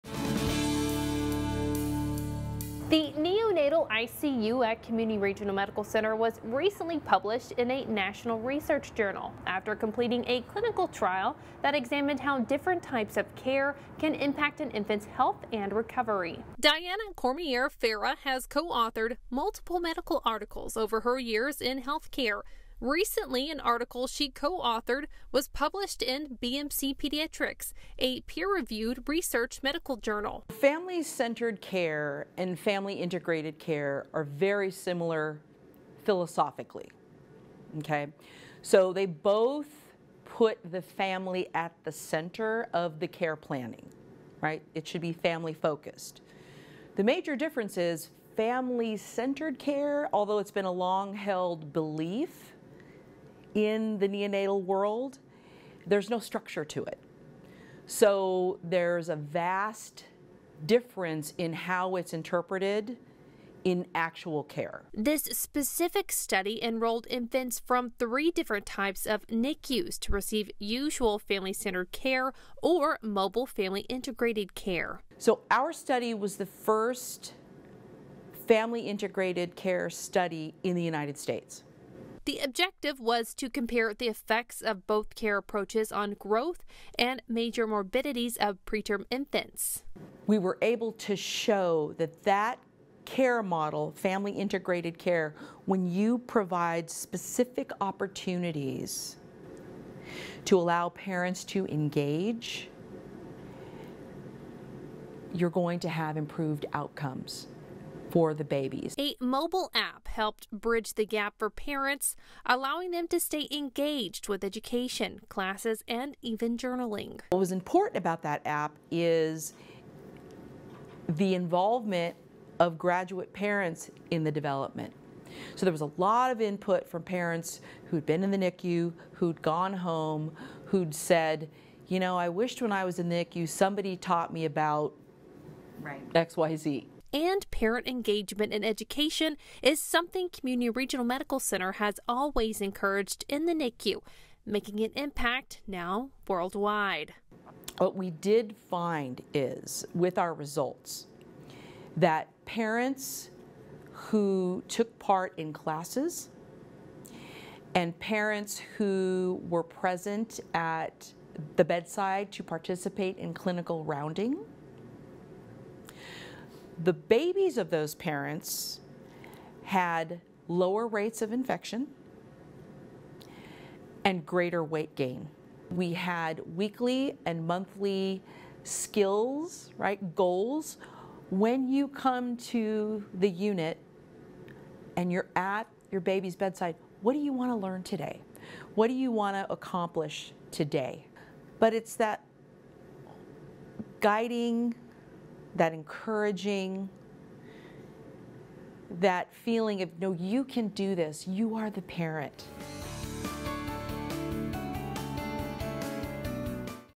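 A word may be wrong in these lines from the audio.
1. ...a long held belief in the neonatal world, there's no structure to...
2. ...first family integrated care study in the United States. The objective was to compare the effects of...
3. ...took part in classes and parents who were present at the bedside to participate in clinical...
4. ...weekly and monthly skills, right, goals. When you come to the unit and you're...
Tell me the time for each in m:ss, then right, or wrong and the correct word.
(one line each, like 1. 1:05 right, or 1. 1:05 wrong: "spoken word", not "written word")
1. 0:50 right
2. 1:16 right
3. 2:34 right
4. 2:56 right.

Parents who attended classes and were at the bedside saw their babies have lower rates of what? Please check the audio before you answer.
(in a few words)
Infection.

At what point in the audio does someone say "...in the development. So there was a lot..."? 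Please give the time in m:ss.
2:04.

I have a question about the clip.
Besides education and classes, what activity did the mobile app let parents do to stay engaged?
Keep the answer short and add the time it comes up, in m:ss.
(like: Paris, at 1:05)
Journaling, at 1:56.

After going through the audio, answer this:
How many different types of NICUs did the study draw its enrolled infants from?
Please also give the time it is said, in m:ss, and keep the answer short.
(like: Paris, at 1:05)
3, at 1:07.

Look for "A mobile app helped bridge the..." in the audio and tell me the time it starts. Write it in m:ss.
1:48.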